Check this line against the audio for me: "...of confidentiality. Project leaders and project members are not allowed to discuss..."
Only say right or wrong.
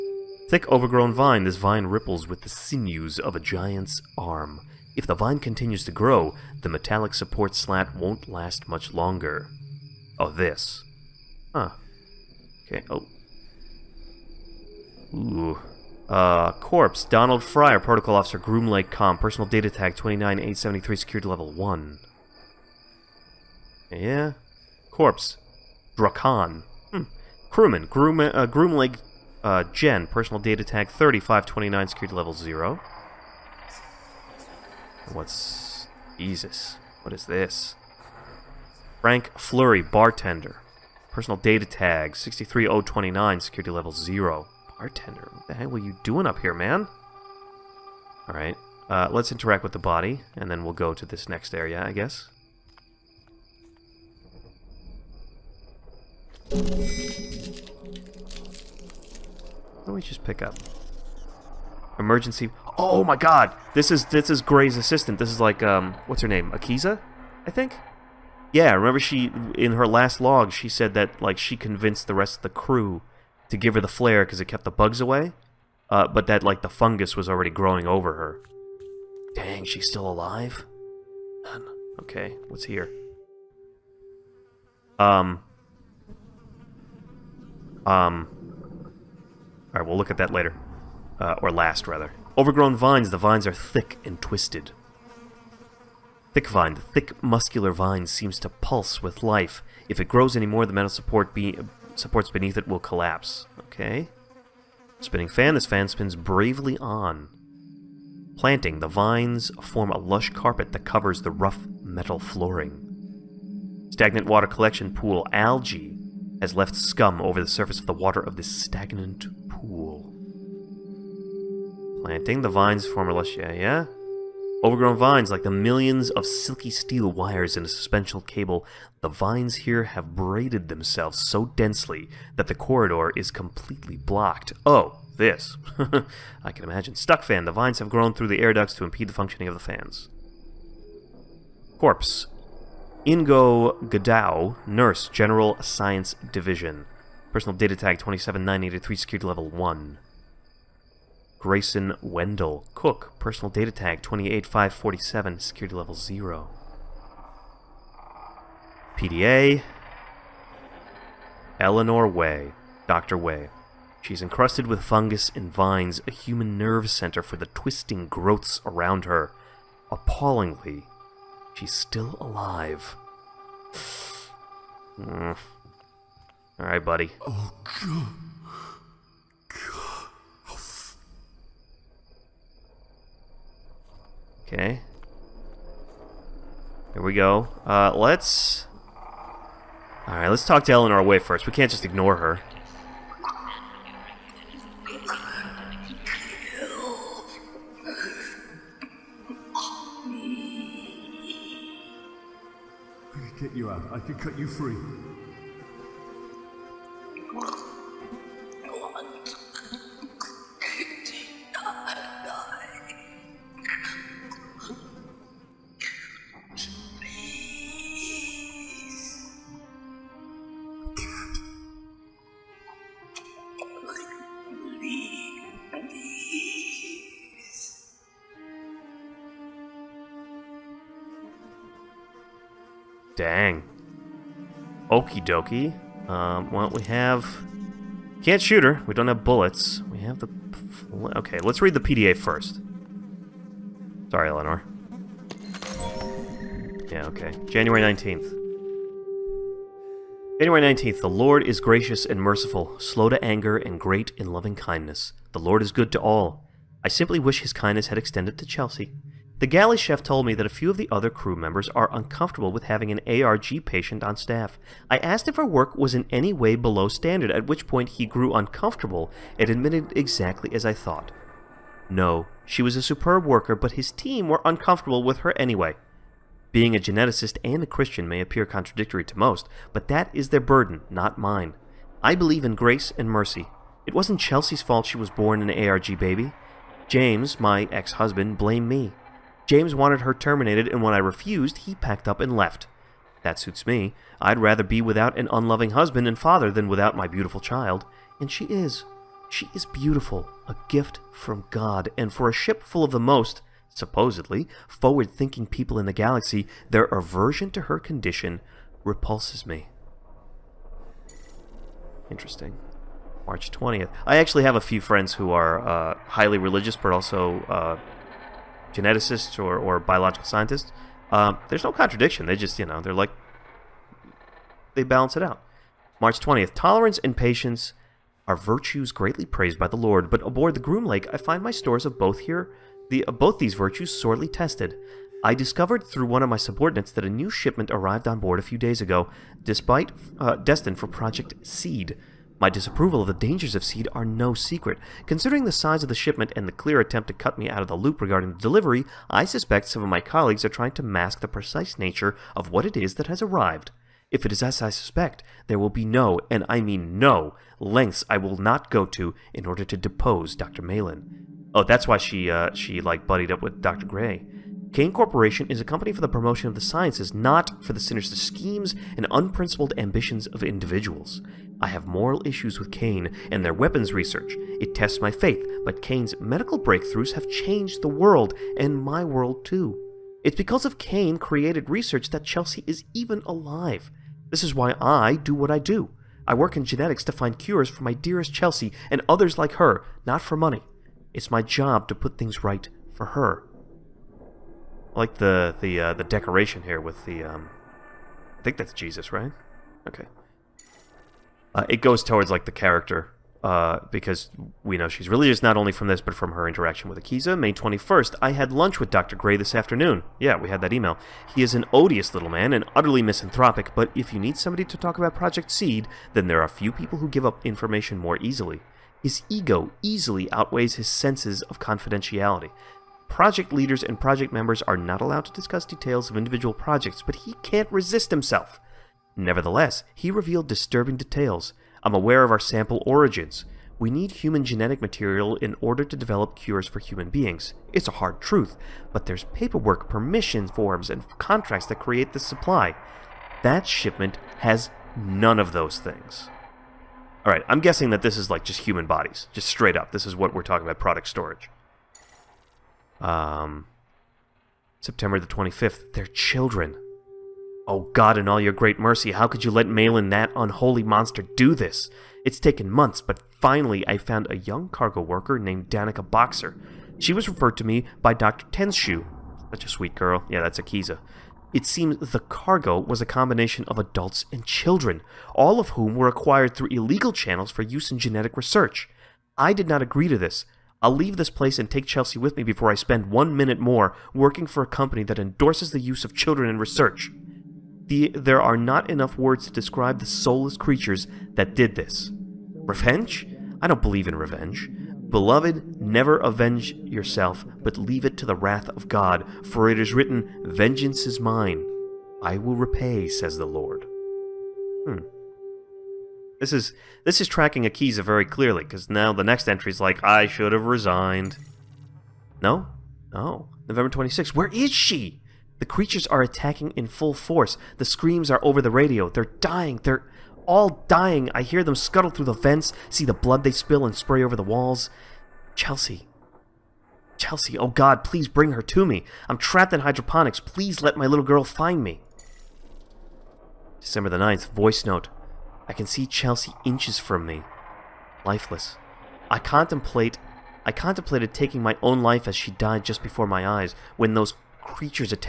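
right.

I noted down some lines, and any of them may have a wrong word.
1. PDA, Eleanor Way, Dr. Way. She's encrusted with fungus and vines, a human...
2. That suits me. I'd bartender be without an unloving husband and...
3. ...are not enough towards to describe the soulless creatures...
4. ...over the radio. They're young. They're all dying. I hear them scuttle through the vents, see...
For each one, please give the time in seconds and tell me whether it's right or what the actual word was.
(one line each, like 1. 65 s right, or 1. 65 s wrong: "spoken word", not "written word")
1. 158 s right
2. 293 s wrong: "rather", not "bartender"
3. 488 s wrong: "words", not "towards"
4. 518 s wrong: "dying", not "young".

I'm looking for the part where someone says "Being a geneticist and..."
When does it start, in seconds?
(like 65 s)
276 s.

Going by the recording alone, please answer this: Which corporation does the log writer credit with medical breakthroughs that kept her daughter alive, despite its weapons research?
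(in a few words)
Cayne Corporation.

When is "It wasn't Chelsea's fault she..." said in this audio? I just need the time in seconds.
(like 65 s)
283 s.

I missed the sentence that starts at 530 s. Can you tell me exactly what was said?
Please let my little girl find me.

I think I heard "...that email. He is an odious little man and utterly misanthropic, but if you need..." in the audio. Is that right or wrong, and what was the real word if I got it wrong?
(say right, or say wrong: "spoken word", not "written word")
right.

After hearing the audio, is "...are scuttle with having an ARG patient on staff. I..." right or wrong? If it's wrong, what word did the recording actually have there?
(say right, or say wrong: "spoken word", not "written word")
wrong: "uncomfortable", not "scuttle".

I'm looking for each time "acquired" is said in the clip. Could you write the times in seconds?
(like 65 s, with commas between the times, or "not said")
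476 s.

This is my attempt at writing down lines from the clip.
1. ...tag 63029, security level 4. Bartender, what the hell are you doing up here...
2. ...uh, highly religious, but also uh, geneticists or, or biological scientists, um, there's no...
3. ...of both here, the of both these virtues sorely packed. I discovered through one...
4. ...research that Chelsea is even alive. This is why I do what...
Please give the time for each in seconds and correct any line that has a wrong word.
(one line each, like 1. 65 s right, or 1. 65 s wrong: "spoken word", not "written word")
1. 41 s wrong: "0", not "4"
2. 315 s right
3. 331 s wrong: "tested", not "packed"
4. 381 s right.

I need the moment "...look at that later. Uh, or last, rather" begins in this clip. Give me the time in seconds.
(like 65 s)
89 s.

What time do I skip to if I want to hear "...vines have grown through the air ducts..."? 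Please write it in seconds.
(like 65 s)
137 s.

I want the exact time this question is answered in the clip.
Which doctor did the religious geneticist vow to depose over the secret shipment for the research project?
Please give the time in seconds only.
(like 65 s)
360 s.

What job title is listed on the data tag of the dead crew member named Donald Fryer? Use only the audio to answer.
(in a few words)
Protocol Officer.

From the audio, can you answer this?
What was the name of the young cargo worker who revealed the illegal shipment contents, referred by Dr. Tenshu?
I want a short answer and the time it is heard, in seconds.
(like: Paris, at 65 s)
Danica Boxer, at 465 s.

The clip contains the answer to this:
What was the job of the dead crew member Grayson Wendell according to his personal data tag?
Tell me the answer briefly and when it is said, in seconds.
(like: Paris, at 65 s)
Cook, at 152 s.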